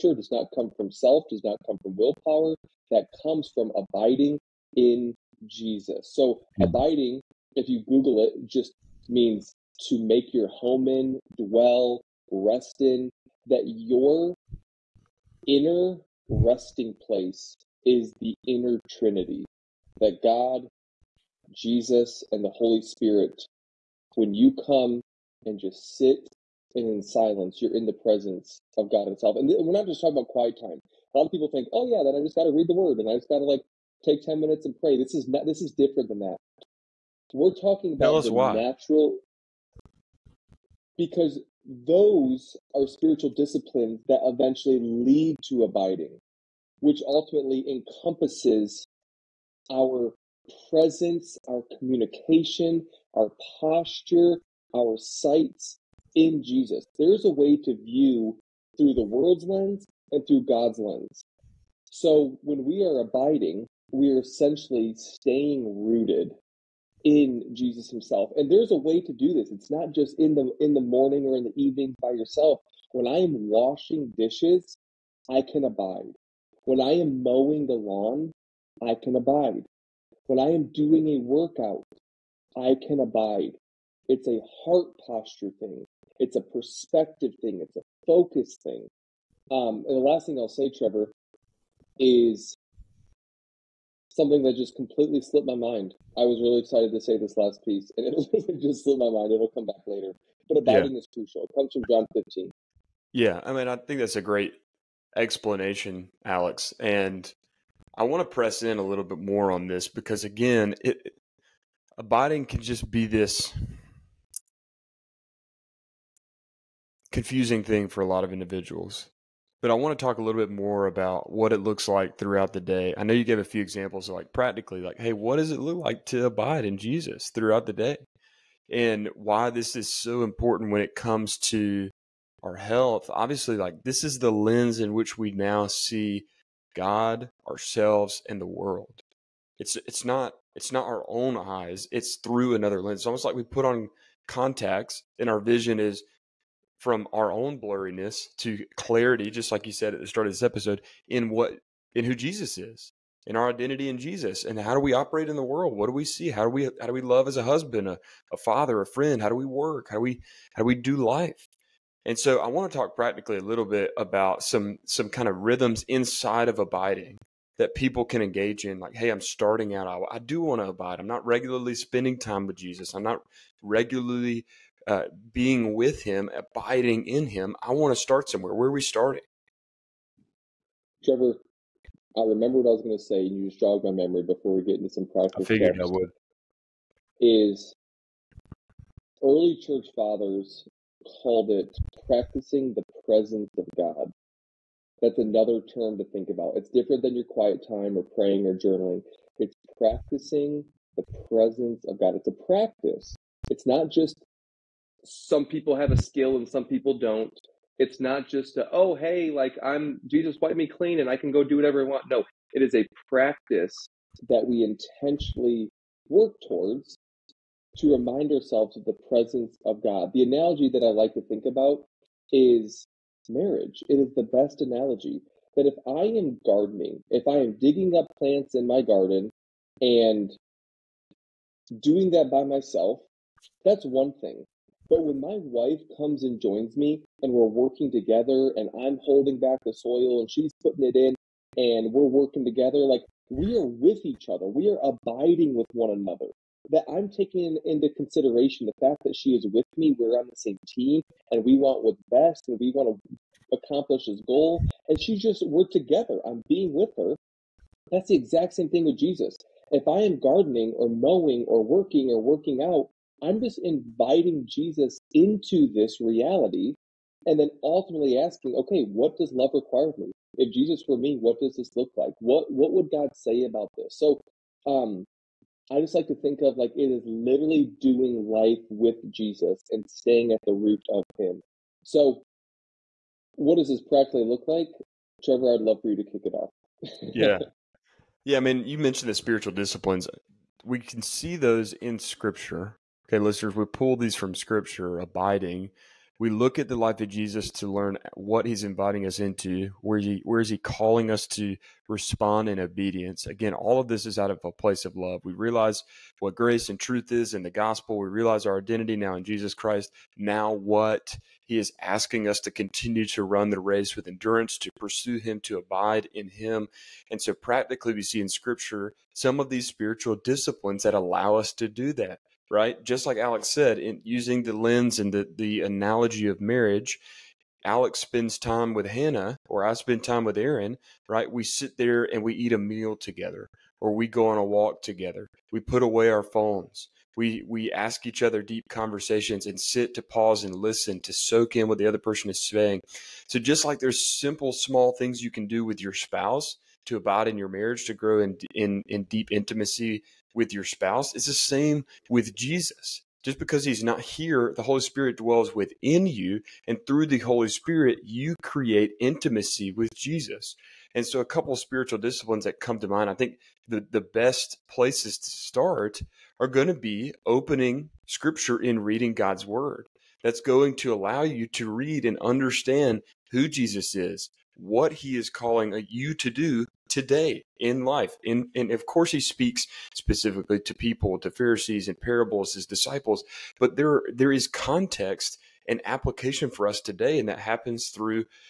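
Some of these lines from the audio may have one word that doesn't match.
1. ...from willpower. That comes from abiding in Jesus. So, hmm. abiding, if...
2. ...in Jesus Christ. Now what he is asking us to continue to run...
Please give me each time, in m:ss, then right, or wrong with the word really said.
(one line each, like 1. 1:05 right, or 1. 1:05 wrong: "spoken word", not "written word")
1. 0:01 right
2. 5:09 right.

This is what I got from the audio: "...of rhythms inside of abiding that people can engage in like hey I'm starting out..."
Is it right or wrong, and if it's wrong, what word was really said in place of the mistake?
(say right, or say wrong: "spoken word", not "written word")
right.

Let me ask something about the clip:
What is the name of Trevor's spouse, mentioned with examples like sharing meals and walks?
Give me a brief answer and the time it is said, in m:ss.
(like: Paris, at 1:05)
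Aaron, at 5:30.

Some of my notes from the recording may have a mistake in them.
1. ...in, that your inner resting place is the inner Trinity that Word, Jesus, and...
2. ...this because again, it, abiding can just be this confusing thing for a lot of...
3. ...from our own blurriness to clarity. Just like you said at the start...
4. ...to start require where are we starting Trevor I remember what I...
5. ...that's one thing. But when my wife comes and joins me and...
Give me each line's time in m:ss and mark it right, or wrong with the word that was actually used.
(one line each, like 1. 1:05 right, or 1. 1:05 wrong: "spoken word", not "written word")
1. 0:12 wrong: "God", not "Word"
2. 1:49 right
3. 2:26 right
4. 2:57 wrong: "somewhere", not "require"
5. 3:53 right.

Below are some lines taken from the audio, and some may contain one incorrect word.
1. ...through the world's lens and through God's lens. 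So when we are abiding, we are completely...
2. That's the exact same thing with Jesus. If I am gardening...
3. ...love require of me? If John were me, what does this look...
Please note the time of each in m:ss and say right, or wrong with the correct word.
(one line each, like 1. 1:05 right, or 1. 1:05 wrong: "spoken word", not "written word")
1. 0:58 wrong: "essentially", not "completely"
2. 4:17 right
3. 4:29 wrong: "Jesus", not "John".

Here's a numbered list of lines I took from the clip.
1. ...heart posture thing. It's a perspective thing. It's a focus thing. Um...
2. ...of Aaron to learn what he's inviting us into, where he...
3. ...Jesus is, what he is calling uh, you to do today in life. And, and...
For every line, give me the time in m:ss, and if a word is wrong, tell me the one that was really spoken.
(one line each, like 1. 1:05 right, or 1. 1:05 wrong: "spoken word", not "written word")
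1. 1:24 right
2. 4:57 wrong: "Jesus", not "Aaron"
3. 6:13 right.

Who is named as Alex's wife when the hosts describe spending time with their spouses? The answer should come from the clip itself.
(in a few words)
Hannah.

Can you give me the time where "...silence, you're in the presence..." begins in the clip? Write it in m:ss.
0:27.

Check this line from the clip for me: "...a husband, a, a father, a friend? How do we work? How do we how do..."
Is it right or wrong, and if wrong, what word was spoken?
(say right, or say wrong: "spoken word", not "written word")
right.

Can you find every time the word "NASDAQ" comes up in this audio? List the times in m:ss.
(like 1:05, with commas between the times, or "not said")
not said.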